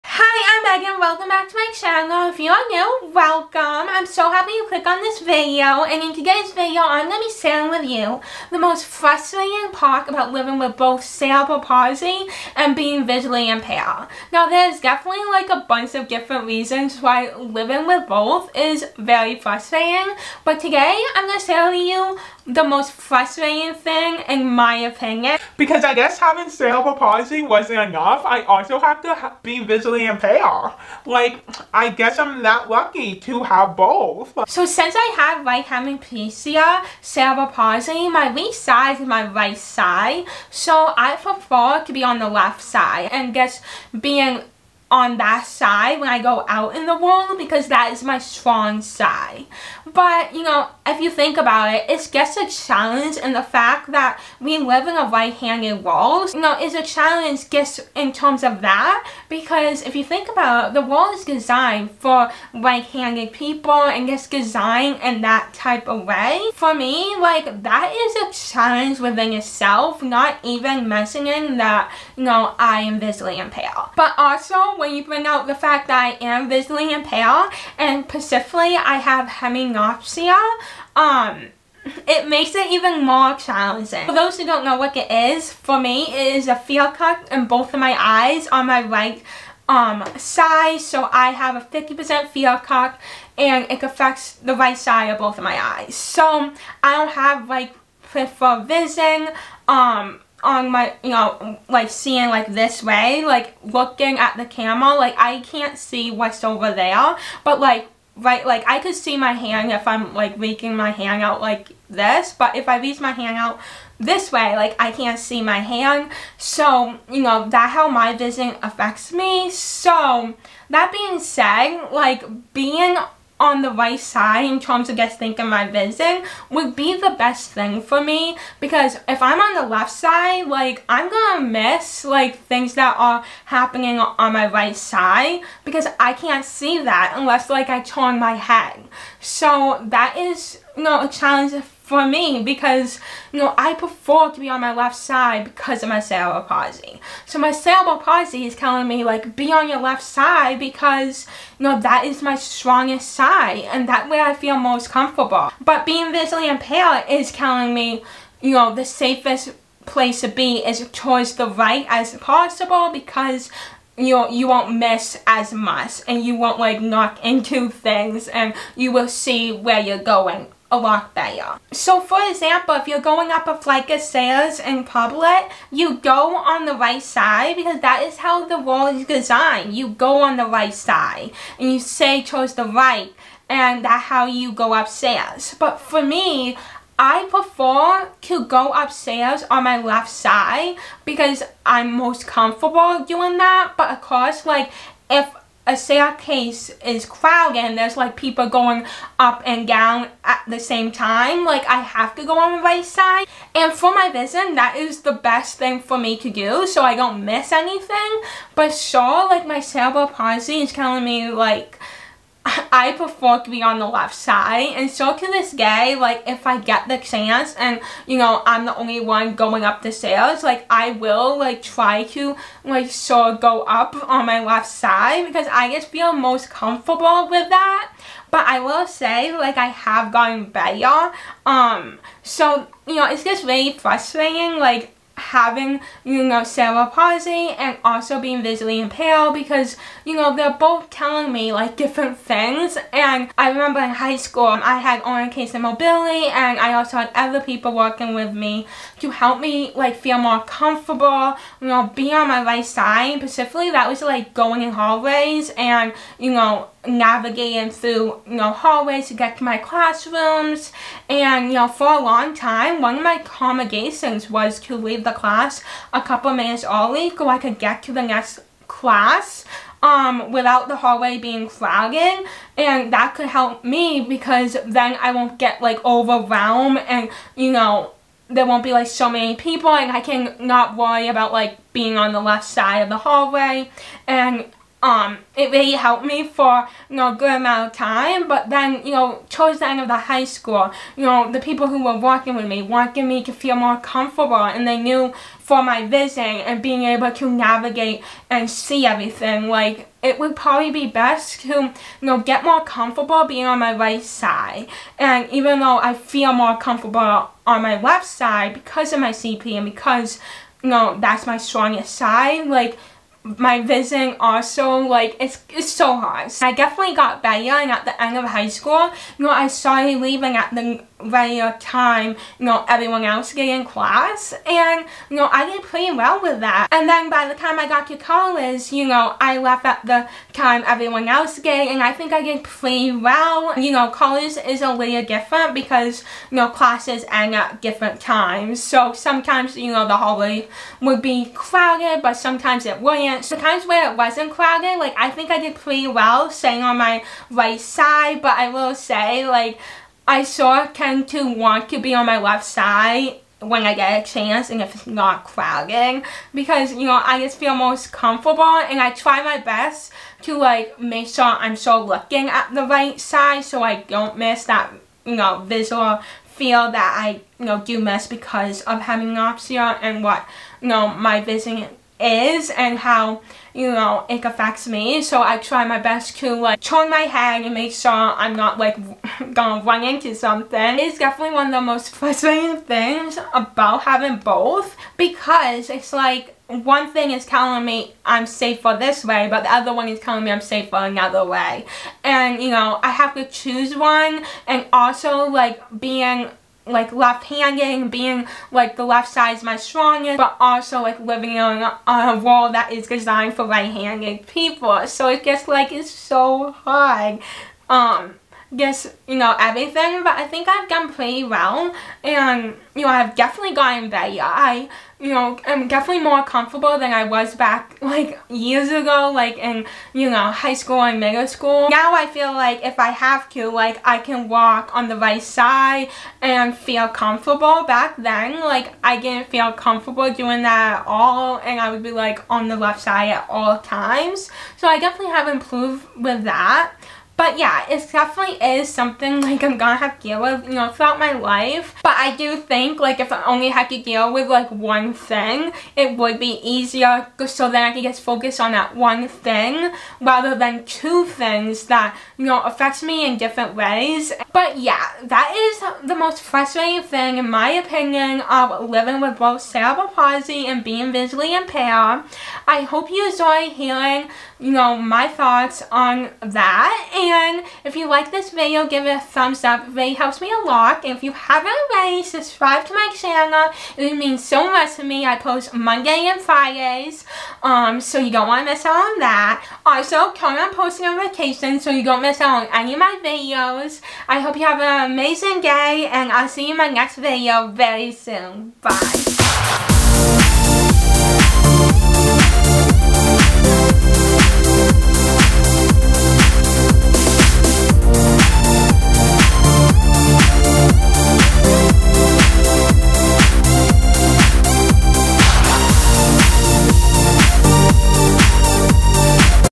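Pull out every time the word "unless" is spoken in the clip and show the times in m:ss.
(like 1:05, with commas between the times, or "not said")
2:17.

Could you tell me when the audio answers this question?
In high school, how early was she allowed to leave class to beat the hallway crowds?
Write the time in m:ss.
4:25.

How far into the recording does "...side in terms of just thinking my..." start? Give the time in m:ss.
2:03.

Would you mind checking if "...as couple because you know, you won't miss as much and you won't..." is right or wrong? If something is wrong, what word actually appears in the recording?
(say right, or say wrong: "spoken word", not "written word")
wrong: "possible", not "couple".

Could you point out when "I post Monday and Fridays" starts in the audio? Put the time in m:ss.
7:55.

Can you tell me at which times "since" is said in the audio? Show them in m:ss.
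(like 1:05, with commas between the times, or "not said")
0:34.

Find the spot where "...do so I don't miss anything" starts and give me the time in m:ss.
3:26.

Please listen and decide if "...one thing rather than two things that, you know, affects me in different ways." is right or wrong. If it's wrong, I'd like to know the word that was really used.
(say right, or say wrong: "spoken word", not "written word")
right.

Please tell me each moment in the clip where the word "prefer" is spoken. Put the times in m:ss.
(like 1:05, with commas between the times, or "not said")
0:41, 2:23, 3:07, 3:32.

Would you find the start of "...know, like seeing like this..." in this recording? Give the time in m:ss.
1:41.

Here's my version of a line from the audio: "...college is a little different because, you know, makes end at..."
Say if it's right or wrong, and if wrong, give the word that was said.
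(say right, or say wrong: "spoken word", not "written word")
wrong: "classes", not "makes".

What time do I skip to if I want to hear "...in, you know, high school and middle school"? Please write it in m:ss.
6:59.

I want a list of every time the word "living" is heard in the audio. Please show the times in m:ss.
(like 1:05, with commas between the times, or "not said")
0:10, 0:17, 6:40, 7:38.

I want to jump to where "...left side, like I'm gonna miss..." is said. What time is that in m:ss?
2:09.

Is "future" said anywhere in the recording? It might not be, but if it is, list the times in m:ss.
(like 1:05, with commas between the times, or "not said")
not said.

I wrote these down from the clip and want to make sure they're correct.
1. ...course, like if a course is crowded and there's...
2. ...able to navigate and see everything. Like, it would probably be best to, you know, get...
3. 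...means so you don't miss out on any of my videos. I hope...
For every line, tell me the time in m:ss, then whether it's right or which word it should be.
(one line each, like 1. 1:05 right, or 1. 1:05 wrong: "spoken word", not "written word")
1. 3:14 wrong: "staircase", not "course"
2. 4:56 right
3. 8:00 wrong: "notifications", not "means".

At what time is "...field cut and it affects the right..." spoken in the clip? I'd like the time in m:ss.
1:32.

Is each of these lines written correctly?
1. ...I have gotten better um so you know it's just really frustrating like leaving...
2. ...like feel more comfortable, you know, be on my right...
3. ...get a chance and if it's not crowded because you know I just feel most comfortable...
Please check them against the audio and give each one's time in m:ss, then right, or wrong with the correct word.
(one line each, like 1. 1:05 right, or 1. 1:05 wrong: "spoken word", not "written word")
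1. 3:49 wrong: "having", not "leaving"
2. 4:09 right
3. 5:53 right.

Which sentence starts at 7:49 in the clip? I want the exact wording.
It really helps me a lot.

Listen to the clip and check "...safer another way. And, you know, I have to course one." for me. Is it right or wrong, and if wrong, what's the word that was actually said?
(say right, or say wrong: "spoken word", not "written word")
wrong: "choose", not "course".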